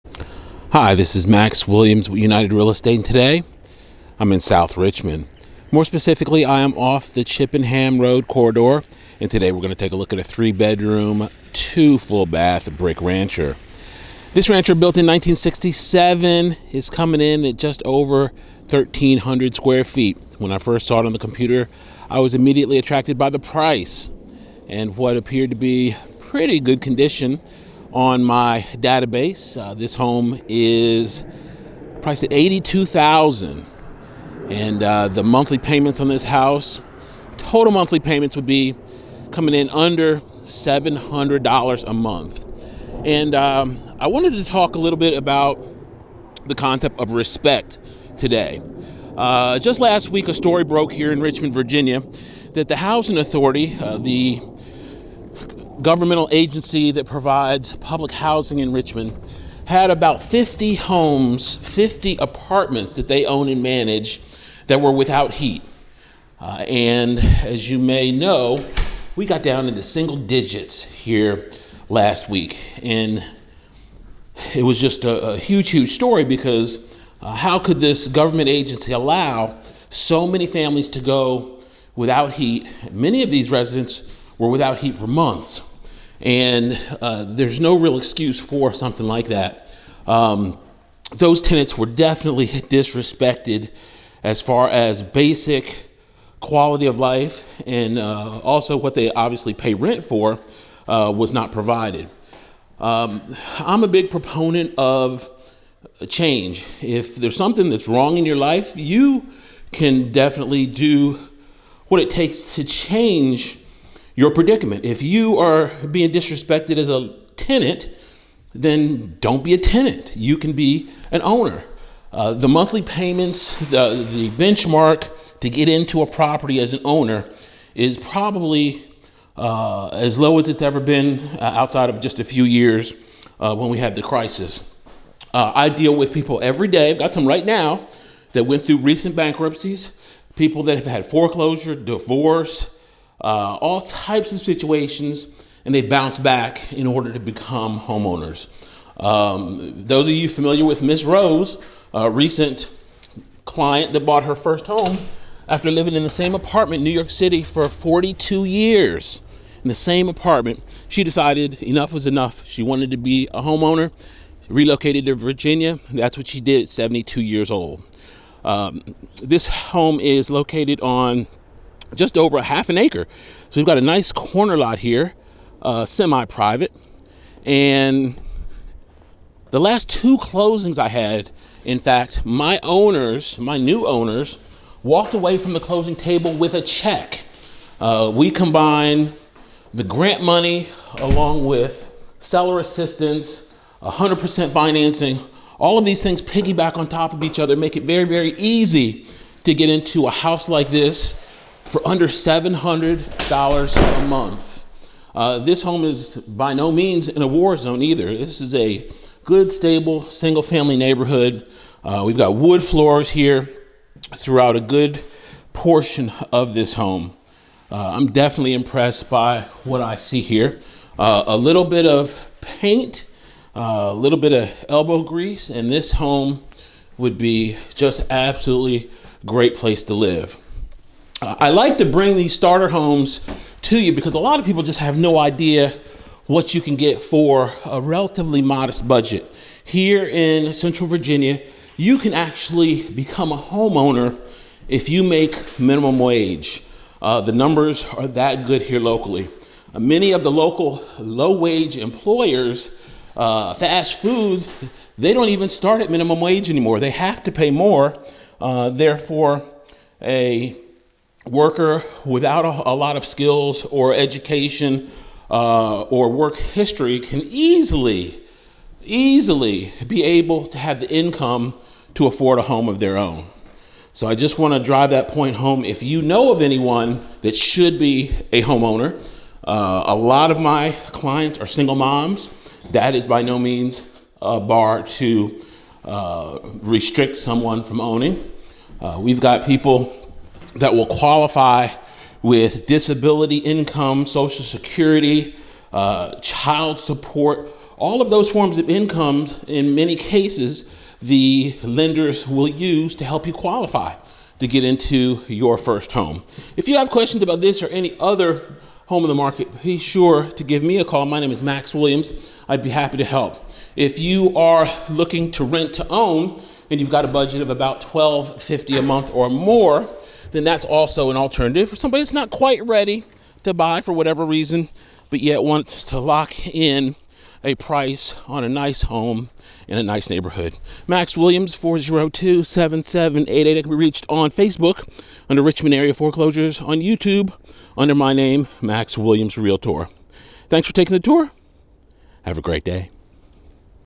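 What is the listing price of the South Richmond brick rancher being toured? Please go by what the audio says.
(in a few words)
$82,000.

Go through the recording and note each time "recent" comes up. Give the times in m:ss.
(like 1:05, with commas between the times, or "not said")
2:18, 2:32.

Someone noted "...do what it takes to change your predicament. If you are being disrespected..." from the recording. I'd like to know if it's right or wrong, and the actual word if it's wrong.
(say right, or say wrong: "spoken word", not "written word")
right.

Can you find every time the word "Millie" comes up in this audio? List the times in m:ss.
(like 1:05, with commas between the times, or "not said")
not said.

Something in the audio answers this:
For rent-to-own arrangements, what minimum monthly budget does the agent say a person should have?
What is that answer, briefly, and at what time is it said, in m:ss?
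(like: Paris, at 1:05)
$1,250, at 5:17.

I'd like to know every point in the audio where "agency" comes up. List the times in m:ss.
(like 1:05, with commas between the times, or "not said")
0:56, 1:18.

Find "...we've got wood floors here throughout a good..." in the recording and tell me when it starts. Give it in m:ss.
3:32.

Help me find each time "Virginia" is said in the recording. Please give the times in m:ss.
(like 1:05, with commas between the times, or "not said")
0:51, 2:45, 4:00.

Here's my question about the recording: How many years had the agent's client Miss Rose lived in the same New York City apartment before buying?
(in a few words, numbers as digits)
42.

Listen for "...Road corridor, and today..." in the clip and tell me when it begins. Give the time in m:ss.
0:07.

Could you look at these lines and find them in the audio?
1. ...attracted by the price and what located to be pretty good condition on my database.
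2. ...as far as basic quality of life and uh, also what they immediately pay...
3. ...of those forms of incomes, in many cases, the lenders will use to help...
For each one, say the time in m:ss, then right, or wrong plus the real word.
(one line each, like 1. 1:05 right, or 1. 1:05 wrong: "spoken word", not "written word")
1. 0:22 wrong: "appeared", not "located"
2. 1:34 wrong: "obviously", not "immediately"
3. 4:58 right.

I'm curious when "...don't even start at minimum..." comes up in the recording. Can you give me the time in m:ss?
4:15.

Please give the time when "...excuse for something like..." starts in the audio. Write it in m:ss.
1:27.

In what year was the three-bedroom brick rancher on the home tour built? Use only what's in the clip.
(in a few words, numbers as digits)
1967.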